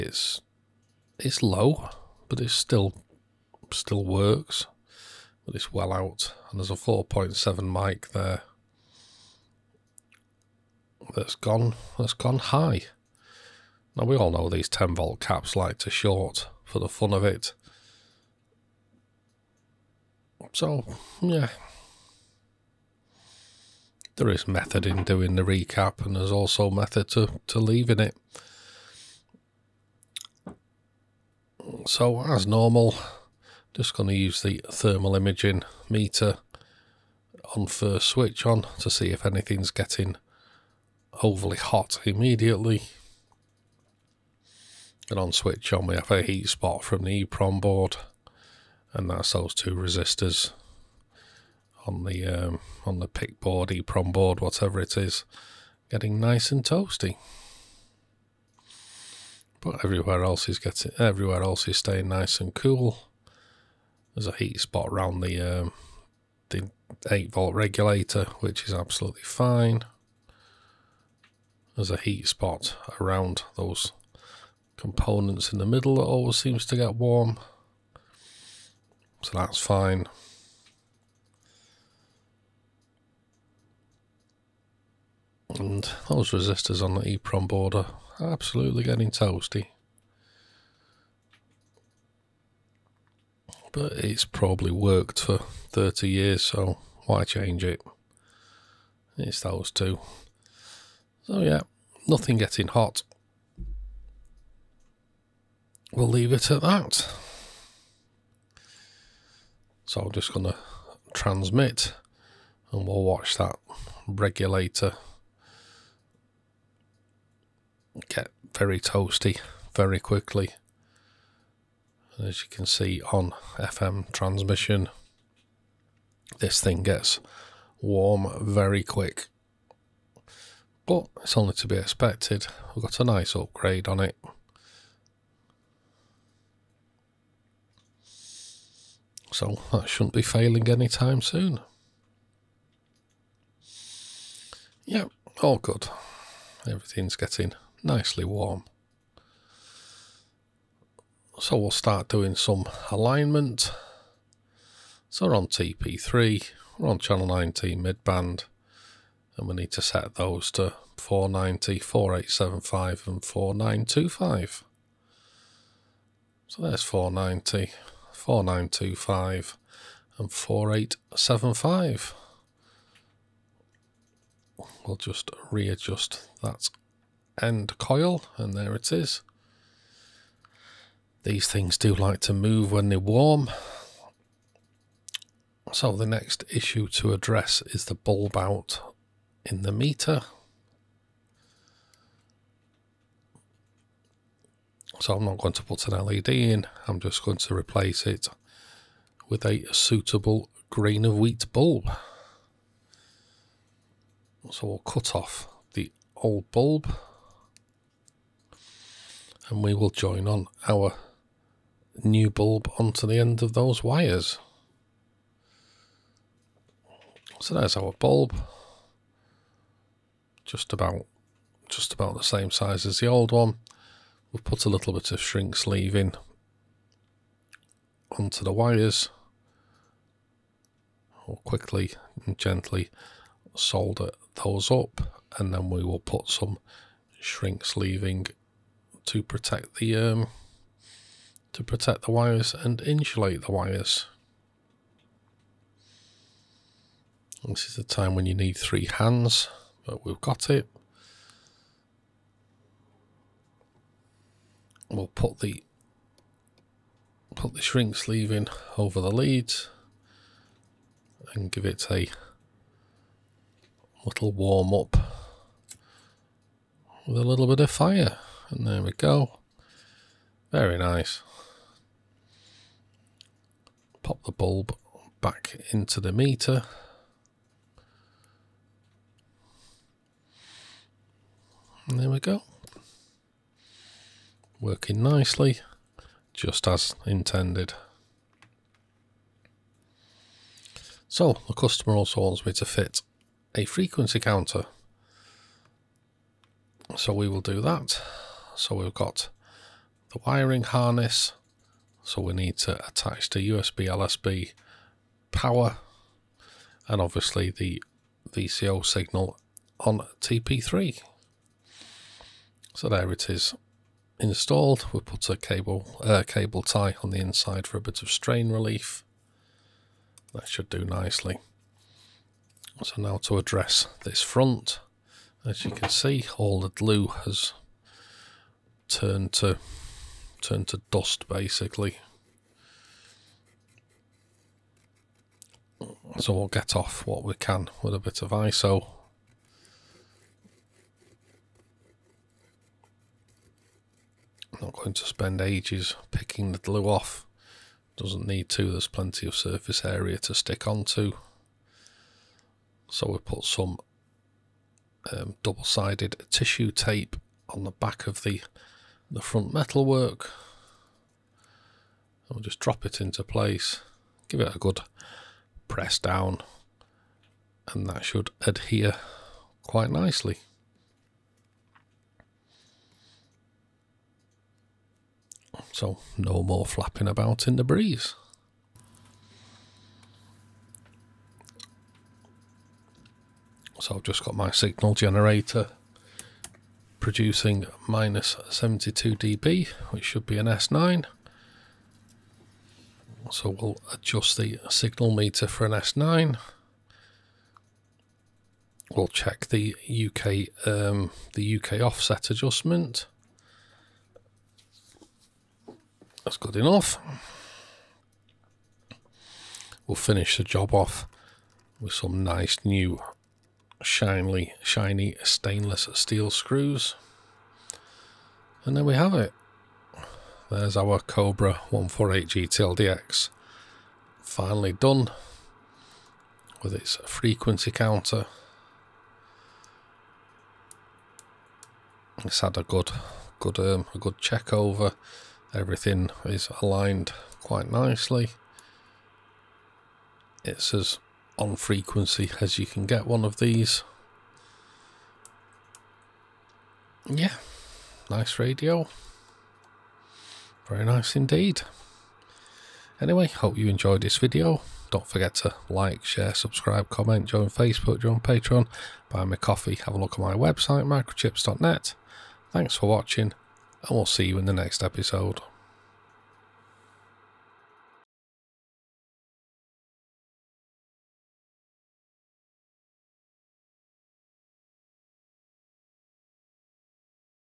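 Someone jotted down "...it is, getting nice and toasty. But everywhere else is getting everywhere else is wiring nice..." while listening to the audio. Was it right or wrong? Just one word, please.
wrong.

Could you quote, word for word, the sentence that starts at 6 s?
And there's a 4.7 mic there.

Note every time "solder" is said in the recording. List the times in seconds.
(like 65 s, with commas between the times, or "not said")
233 s.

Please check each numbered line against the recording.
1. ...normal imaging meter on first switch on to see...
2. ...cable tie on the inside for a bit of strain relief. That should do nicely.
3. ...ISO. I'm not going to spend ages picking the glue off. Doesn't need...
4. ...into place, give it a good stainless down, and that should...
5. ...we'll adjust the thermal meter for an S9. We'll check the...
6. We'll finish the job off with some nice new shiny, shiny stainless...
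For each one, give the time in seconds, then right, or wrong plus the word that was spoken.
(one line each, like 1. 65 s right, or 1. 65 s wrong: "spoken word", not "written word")
1. 34 s wrong: "thermal", not "normal"
2. 316 s right
3. 338 s right
4. 362 s wrong: "press", not "stainless"
5. 393 s wrong: "signal", not "thermal"
6. 409 s right.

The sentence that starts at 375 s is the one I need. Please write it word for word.
So no more flapping about in the breeze.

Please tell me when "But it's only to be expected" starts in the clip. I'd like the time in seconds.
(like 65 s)
130 s.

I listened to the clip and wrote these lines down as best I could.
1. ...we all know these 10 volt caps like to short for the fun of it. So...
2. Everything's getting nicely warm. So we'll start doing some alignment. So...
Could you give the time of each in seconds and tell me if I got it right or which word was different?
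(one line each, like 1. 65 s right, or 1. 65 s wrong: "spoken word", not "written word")
1. 14 s right
2. 146 s right.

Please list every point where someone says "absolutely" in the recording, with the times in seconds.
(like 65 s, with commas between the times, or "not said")
68 s, 88 s.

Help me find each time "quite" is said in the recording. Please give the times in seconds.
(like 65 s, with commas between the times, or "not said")
369 s, 437 s.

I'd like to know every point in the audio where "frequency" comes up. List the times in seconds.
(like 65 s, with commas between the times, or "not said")
293 s, 427 s, 441 s.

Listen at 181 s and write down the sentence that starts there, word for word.
These things do like to move when they're warm.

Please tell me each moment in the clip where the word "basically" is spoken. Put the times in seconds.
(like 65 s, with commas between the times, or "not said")
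331 s.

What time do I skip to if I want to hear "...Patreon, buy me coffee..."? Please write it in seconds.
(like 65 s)
458 s.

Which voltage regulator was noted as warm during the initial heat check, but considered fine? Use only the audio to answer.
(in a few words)
8 volt.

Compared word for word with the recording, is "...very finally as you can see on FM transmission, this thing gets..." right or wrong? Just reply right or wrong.
wrong.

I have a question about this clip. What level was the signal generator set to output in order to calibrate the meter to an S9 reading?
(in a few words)
-72 dB.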